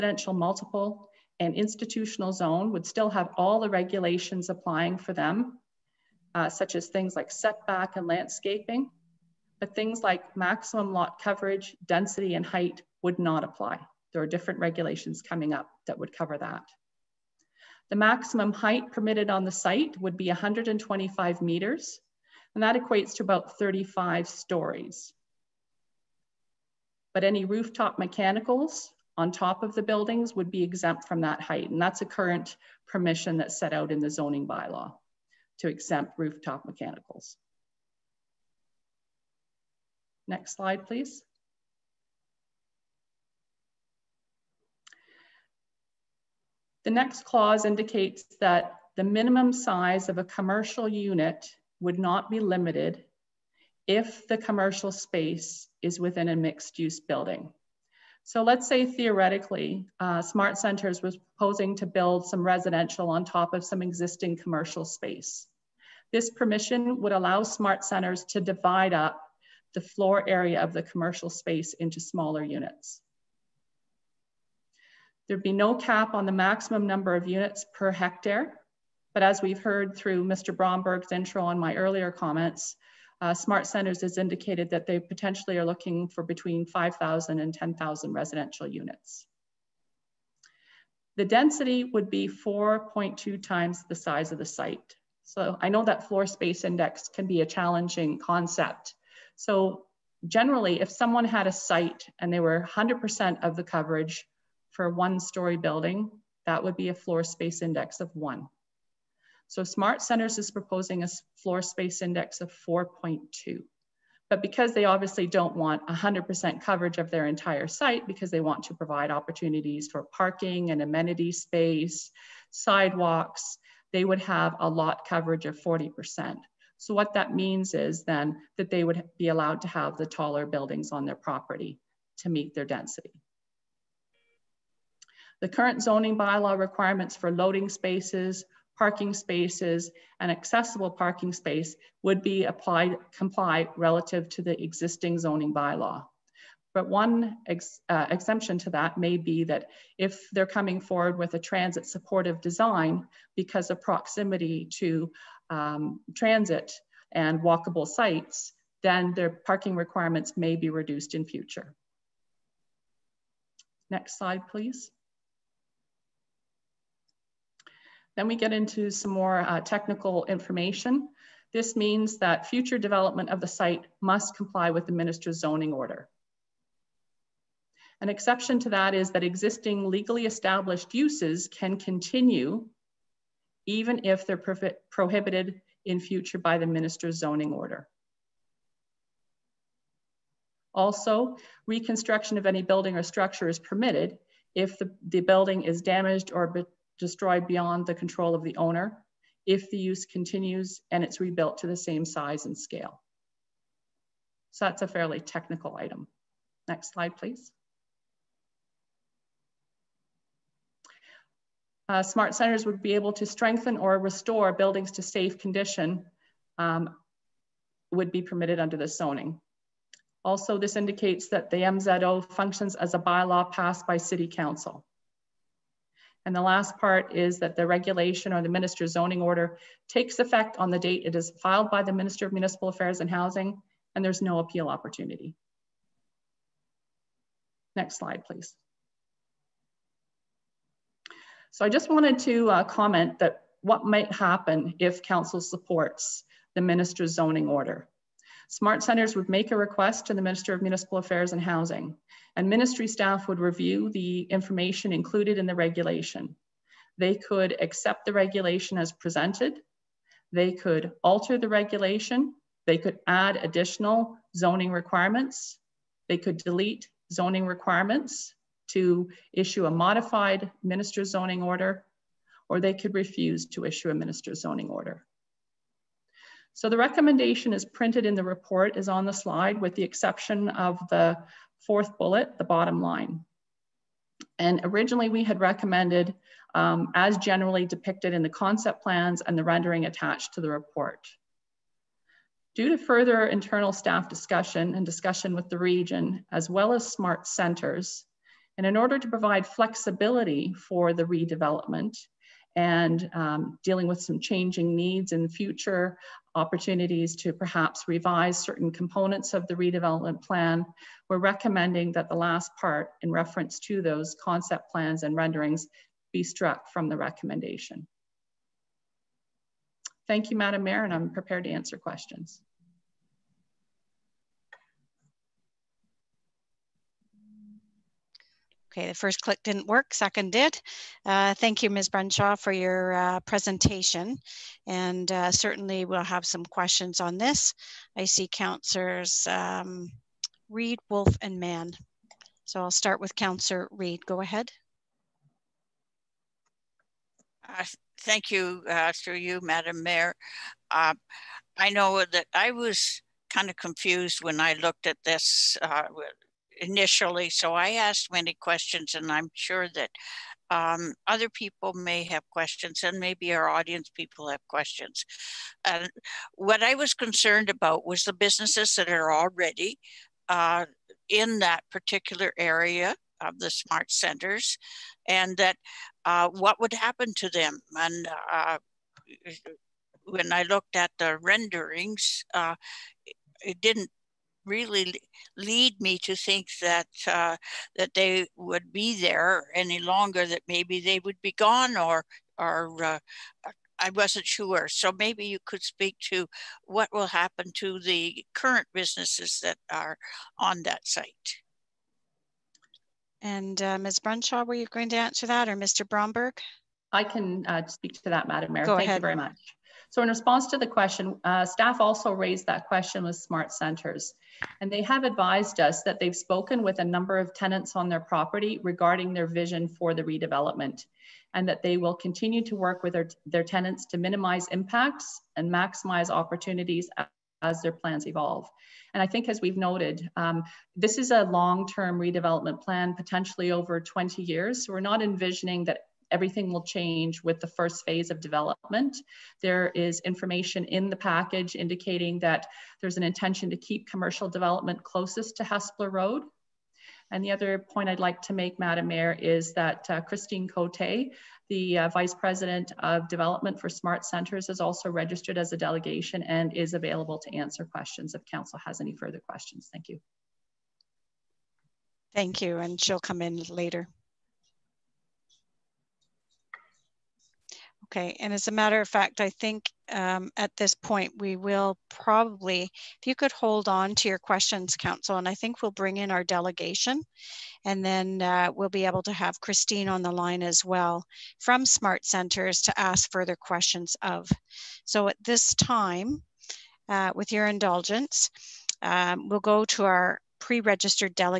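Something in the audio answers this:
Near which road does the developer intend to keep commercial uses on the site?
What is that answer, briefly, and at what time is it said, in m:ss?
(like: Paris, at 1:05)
Hespeler Road, at 7:25.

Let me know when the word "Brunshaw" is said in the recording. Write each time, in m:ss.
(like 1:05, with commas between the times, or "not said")
5:31, 6:43.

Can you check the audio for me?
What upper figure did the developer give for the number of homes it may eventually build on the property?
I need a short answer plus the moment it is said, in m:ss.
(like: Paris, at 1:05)
10,000, at 1:27.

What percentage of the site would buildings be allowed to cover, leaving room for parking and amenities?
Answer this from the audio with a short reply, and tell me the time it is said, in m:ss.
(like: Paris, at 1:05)
40%, at 2:05.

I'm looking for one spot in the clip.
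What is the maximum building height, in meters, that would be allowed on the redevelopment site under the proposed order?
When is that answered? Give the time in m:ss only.
0:20.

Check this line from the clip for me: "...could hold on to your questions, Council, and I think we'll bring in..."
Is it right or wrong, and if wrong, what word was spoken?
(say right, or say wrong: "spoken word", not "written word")
right.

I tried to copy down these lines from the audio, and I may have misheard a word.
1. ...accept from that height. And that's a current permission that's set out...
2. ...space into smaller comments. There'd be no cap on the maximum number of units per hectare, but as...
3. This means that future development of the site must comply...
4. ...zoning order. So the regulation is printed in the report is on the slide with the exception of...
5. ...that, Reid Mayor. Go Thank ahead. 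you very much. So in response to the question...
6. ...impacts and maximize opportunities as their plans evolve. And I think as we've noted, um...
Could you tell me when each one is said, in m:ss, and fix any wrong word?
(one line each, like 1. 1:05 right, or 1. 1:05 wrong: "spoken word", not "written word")
1. 0:30 wrong: "exempt", not "accept"
2. 1:11 wrong: "units", not "comments"
3. 2:51 right
4. 4:34 wrong: "recommendation", not "regulation"
5. 6:48 wrong: "Madam", not "Reid"
6. 7:04 right.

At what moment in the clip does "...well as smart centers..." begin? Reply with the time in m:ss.
4:56.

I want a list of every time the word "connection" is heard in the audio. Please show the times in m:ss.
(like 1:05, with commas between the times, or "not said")
not said.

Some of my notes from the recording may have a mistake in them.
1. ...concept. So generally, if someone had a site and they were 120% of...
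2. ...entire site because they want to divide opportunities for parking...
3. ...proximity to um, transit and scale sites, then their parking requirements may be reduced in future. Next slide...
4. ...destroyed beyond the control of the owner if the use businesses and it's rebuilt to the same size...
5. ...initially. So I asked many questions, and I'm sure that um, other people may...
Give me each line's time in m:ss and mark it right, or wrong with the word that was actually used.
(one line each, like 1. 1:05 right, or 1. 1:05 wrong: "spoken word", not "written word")
1. 1:38 wrong: "100", not "120"
2. 1:57 wrong: "provide", not "divide"
3. 2:33 wrong: "walkable", not "scale"
4. 3:16 wrong: "continues", not "businesses"
5. 5:56 right.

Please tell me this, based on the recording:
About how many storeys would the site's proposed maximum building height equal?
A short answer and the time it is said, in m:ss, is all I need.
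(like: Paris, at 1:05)
35, at 0:23.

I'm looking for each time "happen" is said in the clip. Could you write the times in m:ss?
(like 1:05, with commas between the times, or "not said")
4:04, 6:16, 6:37.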